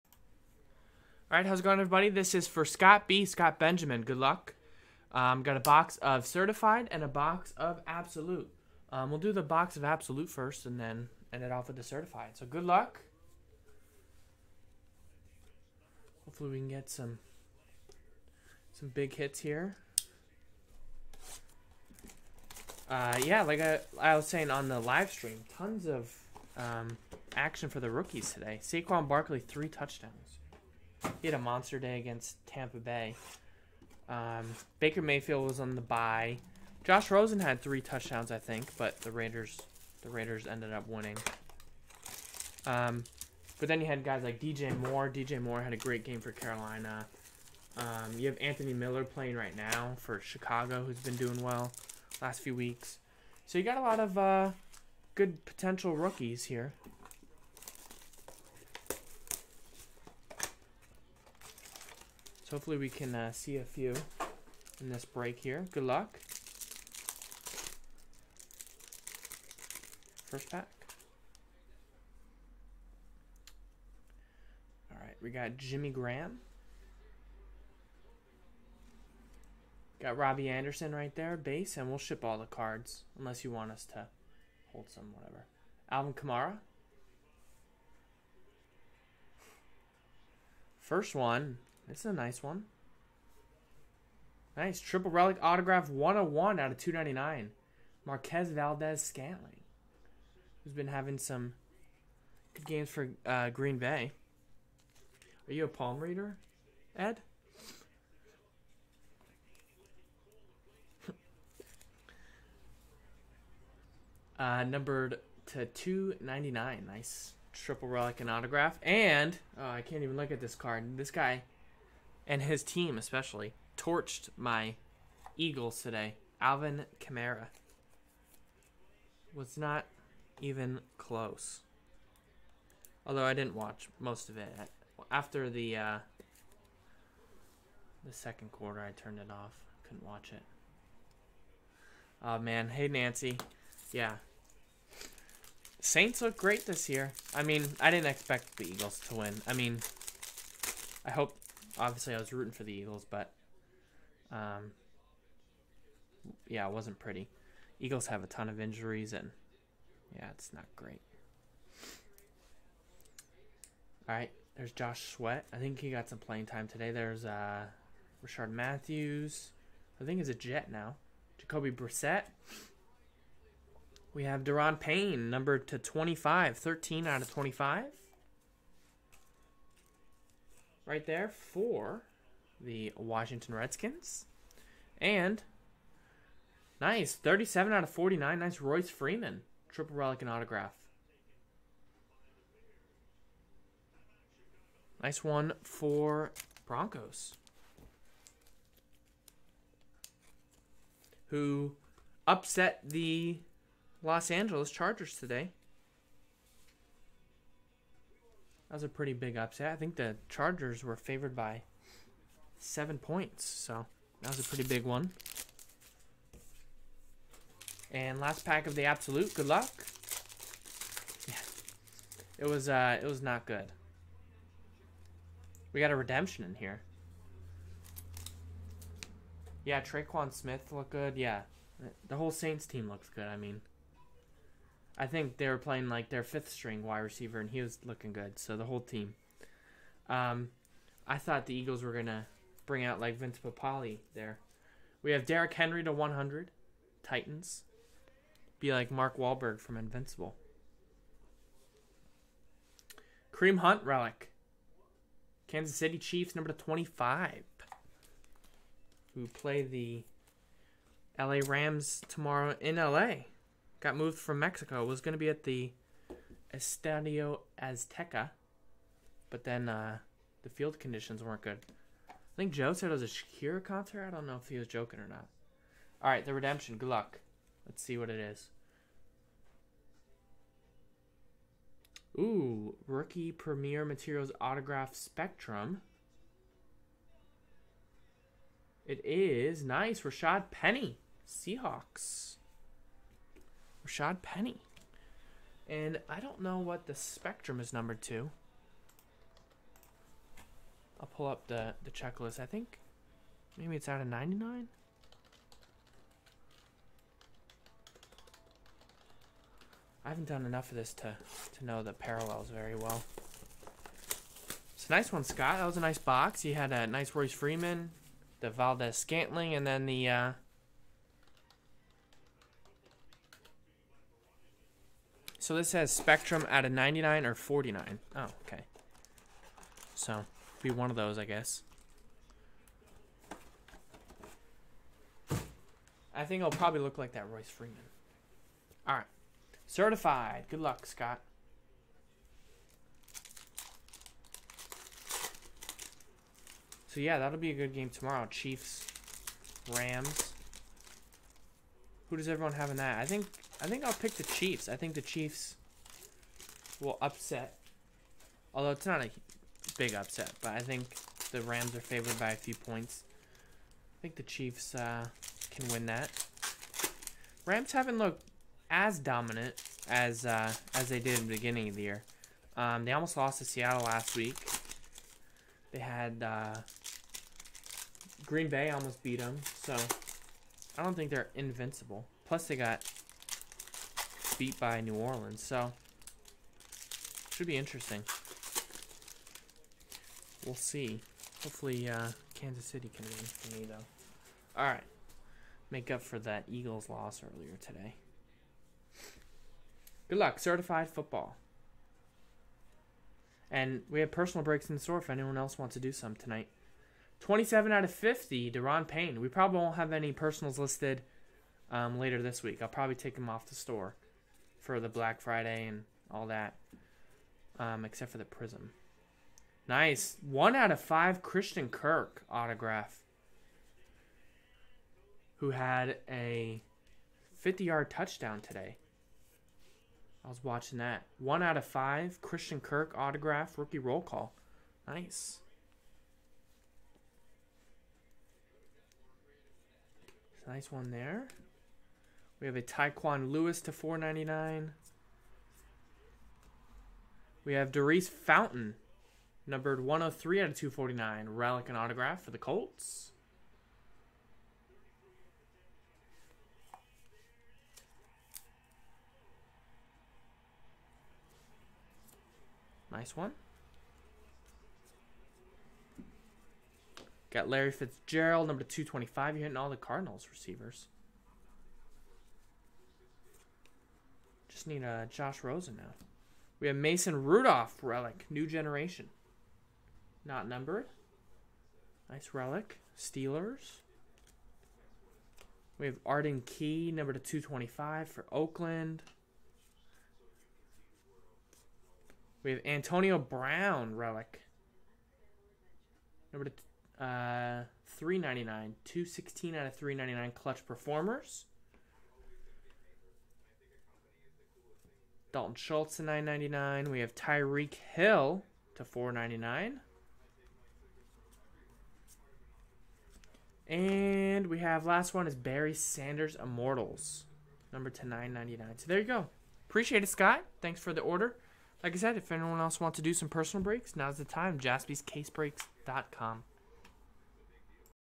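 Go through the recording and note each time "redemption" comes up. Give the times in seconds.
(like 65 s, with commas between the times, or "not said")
225 s, 276 s.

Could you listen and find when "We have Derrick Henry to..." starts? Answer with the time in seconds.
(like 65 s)
245 s.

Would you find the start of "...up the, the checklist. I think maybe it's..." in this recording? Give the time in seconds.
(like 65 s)
301 s.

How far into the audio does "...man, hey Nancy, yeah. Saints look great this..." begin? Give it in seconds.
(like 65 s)
142 s.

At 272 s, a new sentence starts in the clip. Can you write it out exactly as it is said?
I think Joe said it was a Shakira concert.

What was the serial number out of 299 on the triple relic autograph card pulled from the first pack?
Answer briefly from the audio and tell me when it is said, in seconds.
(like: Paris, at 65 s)
101, at 95 s.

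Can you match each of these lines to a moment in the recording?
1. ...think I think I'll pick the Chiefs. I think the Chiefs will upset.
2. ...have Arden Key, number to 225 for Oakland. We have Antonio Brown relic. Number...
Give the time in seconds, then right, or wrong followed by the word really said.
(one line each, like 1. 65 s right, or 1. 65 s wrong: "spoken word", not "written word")
1. 353 s right
2. 485 s right.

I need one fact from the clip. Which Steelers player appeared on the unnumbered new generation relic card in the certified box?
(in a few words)
Mason Rudolph.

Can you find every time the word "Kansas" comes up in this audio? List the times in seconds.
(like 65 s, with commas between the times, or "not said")
255 s, 392 s.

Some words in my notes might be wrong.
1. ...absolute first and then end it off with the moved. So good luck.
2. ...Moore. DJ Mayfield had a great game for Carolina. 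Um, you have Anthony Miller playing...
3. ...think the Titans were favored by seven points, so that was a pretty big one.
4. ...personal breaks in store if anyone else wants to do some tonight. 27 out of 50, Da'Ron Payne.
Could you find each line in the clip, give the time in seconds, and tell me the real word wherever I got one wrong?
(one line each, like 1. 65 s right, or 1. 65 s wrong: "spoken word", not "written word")
1. 9 s wrong: "certified", not "moved"
2. 44 s wrong: "Moore", not "Mayfield"
3. 209 s wrong: "Chargers", not "Titans"
4. 404 s right.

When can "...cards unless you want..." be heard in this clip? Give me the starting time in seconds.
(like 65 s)
82 s.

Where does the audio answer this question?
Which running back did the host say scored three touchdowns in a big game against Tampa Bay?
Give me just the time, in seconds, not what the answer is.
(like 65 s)
28 s.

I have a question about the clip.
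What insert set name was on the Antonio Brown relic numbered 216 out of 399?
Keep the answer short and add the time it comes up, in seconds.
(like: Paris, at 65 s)
Clutch Performers, at 500 s.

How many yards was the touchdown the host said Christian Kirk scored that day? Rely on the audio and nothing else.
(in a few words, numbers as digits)
50.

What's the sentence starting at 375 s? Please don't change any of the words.
They had uh, Green Bay almost beat them, so I don't think they're invincible.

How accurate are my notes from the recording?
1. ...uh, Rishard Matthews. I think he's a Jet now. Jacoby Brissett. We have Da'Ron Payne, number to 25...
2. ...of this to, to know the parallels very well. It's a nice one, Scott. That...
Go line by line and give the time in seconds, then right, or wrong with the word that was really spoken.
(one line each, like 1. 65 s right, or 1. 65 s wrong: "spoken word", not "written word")
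1. 167 s right
2. 310 s right.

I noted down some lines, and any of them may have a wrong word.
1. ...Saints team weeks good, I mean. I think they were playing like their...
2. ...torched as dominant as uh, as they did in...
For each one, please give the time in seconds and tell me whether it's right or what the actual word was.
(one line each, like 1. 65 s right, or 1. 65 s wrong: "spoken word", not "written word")
1. 232 s wrong: "looks", not "weeks"
2. 367 s wrong: "looked", not "torched".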